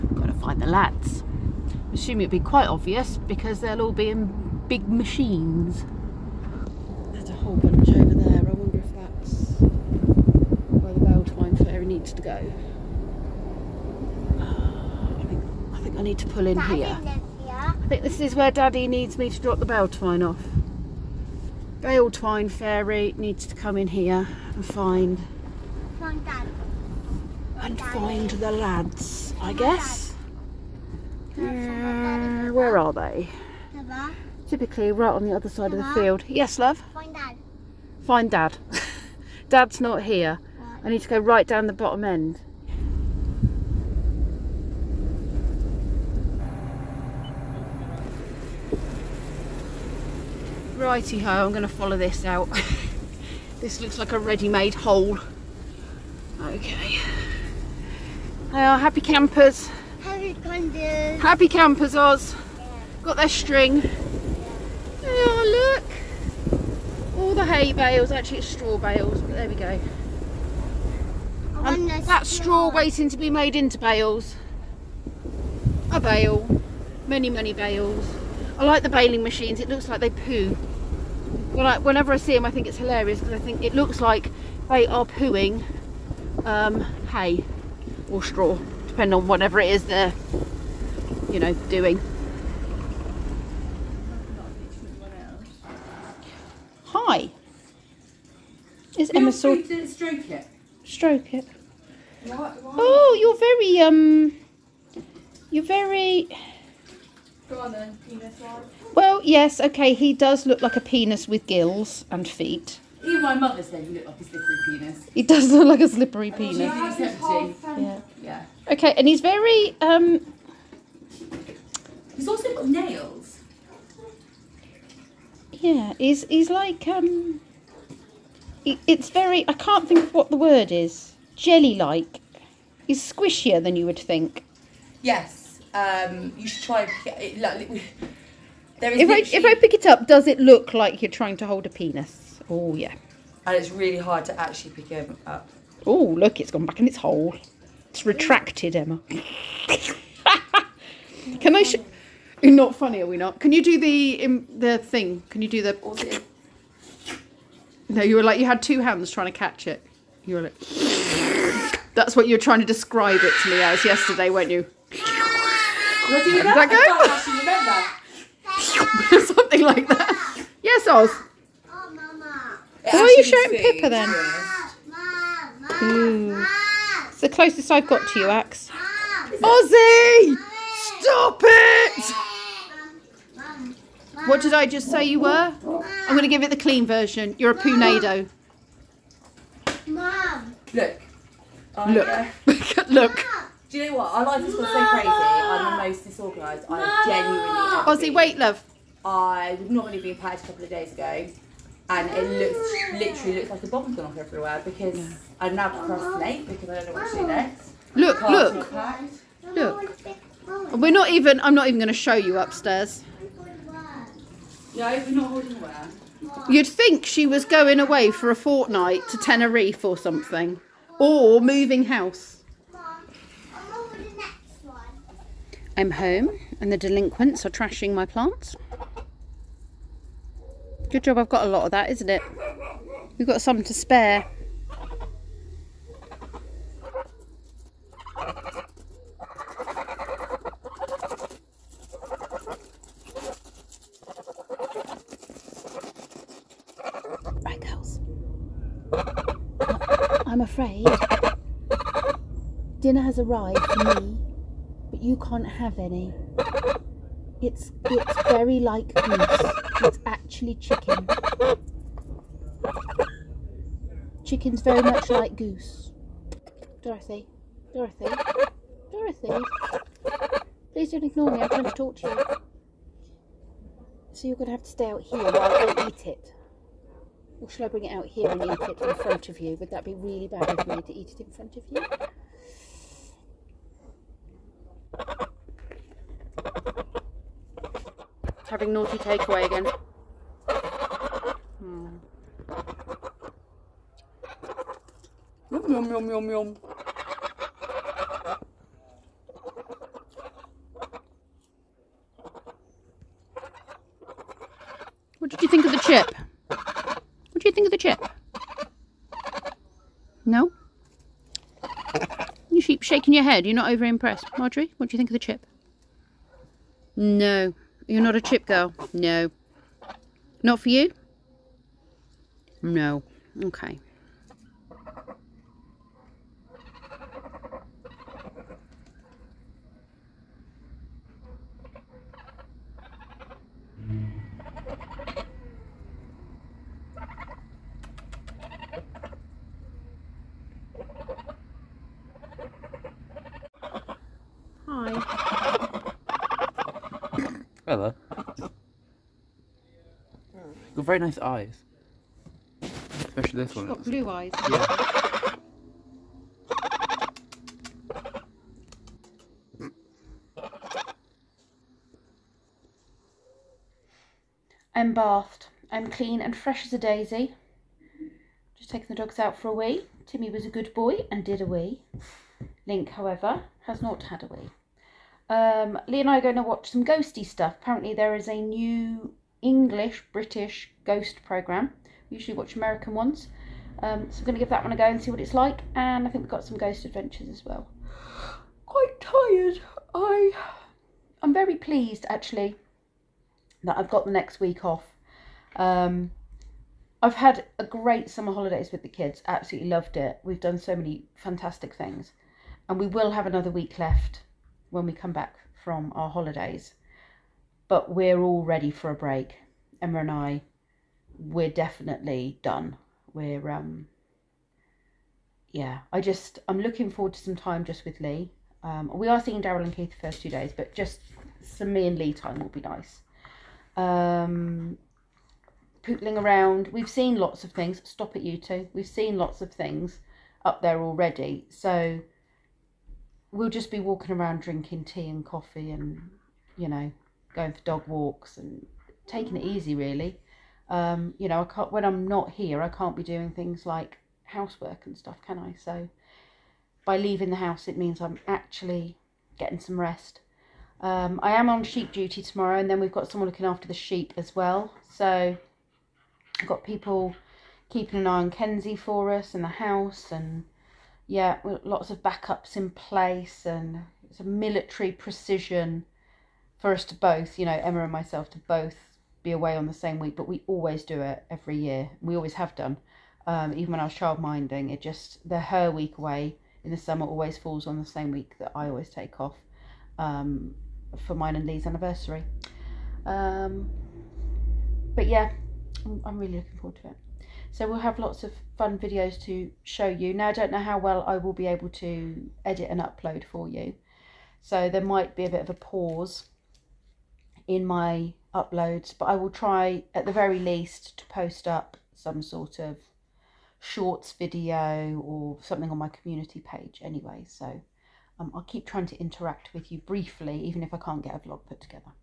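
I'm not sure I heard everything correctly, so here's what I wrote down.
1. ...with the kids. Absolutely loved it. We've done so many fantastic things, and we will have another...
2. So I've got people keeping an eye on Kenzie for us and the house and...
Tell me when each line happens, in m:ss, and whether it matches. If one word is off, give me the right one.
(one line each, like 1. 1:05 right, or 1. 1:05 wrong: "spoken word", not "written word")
1. 6:38 right
2. 7:34 right.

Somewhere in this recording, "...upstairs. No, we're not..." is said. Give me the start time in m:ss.
3:32.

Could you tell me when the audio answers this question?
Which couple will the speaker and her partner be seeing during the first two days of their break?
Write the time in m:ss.
6:59.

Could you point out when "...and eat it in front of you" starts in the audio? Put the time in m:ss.
4:38.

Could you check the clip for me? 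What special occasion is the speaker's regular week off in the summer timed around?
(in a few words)
Anniversary.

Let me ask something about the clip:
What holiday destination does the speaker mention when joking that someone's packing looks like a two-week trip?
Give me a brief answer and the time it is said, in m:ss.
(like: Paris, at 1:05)
Tenerife, at 3:39.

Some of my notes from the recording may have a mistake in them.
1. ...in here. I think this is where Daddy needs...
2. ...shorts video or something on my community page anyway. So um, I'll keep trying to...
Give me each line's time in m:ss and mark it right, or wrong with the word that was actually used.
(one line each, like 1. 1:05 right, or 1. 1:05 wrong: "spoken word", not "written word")
1. 0:16 right
2. 8:23 right.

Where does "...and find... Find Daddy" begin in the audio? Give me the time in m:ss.
0:24.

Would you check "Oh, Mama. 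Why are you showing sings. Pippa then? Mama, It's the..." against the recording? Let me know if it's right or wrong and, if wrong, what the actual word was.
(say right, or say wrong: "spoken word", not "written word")
right.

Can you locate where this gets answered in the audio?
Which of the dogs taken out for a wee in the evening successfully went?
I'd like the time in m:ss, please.
6:10.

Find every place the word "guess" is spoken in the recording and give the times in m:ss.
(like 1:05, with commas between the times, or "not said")
0:29.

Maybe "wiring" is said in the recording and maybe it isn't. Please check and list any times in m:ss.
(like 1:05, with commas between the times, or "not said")
not said.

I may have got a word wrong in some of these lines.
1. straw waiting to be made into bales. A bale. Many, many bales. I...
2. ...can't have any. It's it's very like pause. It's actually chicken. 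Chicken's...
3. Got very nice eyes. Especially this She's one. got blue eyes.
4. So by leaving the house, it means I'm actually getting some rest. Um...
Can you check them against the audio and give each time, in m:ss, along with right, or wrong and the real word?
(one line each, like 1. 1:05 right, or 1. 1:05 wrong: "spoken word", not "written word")
1. 1:12 right
2. 4:15 wrong: "goose", not "pause"
3. 5:50 right
4. 7:25 right.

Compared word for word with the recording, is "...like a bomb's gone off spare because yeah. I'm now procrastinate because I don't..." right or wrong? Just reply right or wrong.
wrong.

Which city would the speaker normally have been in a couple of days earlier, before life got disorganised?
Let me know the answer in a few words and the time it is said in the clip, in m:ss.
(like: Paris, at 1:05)
Paris, at 3:20.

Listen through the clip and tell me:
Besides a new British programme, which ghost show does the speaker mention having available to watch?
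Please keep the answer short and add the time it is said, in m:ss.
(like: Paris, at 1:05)
Ghost Adventures, at 6:26.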